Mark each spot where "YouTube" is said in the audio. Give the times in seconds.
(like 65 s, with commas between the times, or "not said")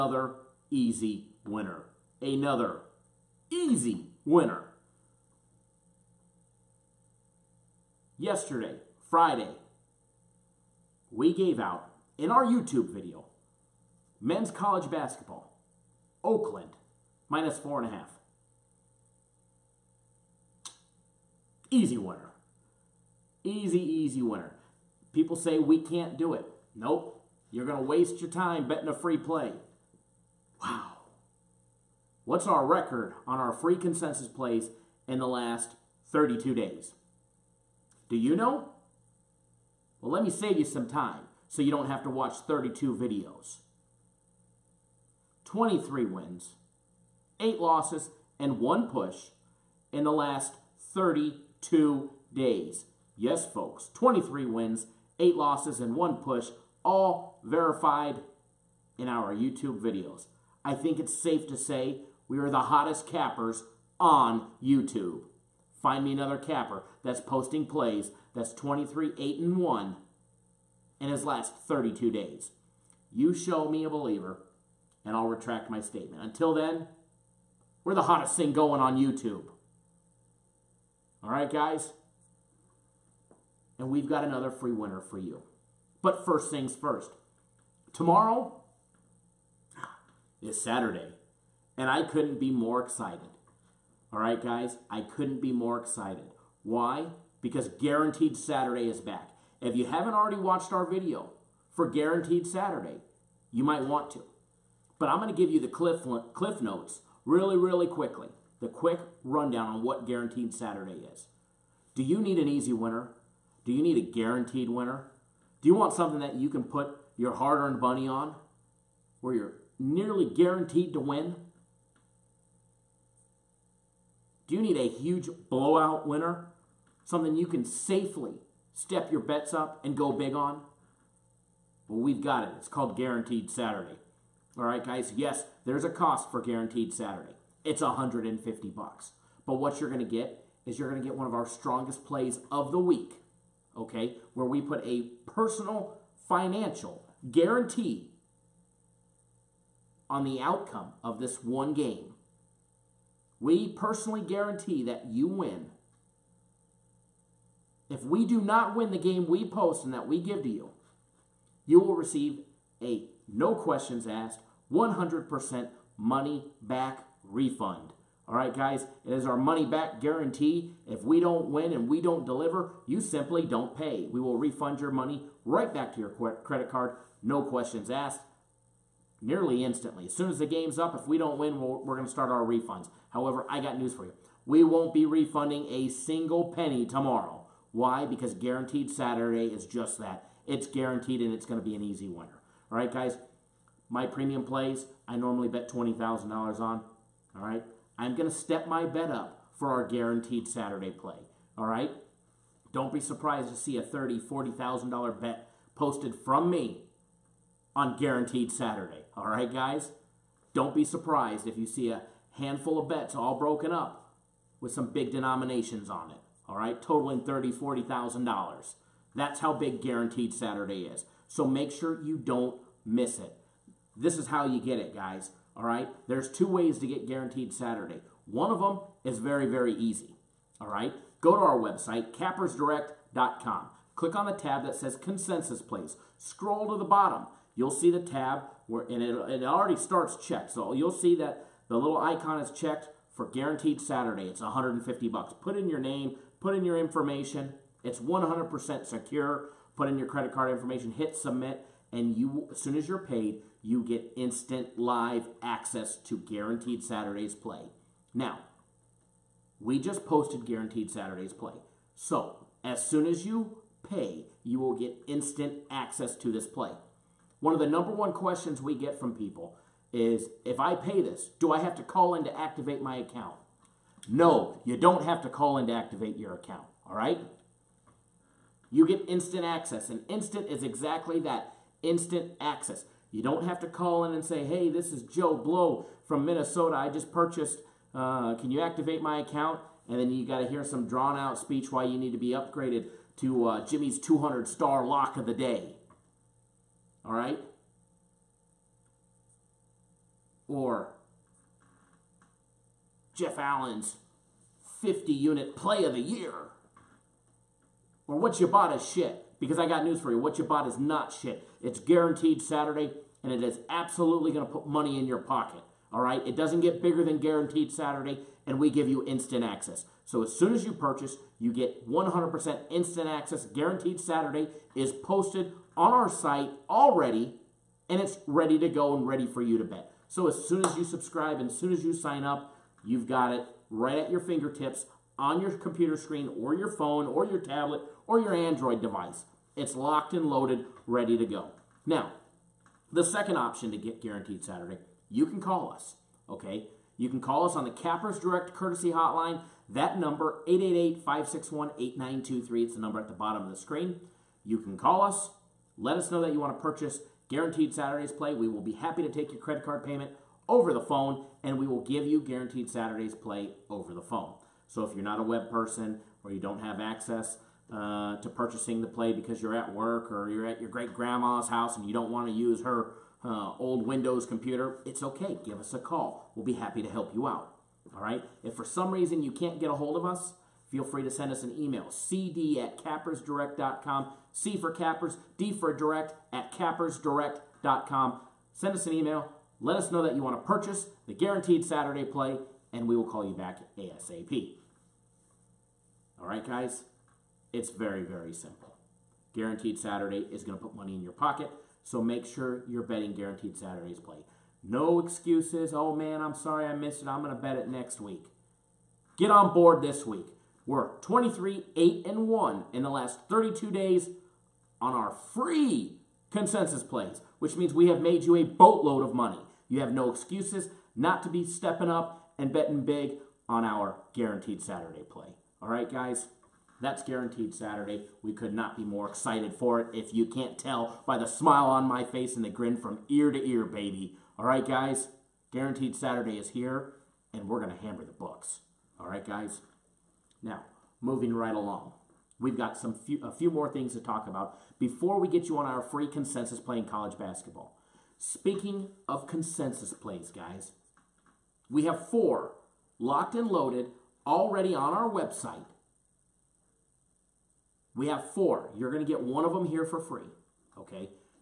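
12 s, 59 s, 64 s, 78 s.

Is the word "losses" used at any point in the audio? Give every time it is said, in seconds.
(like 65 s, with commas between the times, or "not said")
47 s, 55 s.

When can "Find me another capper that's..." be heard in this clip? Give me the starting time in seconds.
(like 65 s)
65 s.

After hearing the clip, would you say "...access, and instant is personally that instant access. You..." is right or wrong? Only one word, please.
wrong.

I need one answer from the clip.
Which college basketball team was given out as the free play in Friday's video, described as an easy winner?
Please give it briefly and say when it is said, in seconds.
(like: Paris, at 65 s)
Oakland, at 16 s.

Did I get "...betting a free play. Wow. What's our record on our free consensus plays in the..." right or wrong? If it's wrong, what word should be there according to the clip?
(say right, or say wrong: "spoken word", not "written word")
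right.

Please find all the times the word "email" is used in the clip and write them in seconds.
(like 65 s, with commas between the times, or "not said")
381 s, 388 s.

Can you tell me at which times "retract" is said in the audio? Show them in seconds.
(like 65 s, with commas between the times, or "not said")
75 s.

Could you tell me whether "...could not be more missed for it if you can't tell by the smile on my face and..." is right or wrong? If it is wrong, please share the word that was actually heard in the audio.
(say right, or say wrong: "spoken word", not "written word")
wrong: "excited", not "missed".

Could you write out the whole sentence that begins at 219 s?
That's how big Guaranteed Saturday is.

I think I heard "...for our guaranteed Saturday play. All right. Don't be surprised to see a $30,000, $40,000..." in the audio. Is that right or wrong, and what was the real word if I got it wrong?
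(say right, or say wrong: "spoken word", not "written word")
right.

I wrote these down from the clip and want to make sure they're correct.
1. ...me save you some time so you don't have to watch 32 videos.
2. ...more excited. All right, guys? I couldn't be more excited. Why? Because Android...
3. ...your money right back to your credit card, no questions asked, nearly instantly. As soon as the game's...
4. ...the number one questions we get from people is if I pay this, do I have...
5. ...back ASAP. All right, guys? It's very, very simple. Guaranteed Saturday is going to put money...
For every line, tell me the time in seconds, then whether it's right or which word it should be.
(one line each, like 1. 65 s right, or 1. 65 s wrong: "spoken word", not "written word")
1. 40 s right
2. 92 s wrong: "Guaranteed", not "Android"
3. 174 s right
4. 267 s right
5. 393 s right.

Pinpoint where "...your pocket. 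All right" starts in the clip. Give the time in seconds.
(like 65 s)
315 s.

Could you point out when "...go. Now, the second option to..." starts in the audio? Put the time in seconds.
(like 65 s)
341 s.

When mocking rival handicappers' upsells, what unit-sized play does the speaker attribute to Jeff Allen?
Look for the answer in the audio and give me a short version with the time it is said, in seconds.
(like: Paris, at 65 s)
50 unit play of the year, at 304 s.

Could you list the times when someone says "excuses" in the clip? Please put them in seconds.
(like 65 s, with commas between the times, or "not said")
404 s, 420 s.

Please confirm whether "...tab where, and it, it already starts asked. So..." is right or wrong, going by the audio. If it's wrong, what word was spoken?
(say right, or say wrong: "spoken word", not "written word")
wrong: "checked", not "asked".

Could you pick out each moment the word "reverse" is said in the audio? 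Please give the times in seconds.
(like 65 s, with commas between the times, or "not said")
not said.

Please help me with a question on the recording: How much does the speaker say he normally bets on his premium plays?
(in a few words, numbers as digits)
$20,000.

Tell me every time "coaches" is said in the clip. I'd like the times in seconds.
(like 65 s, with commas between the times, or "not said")
not said.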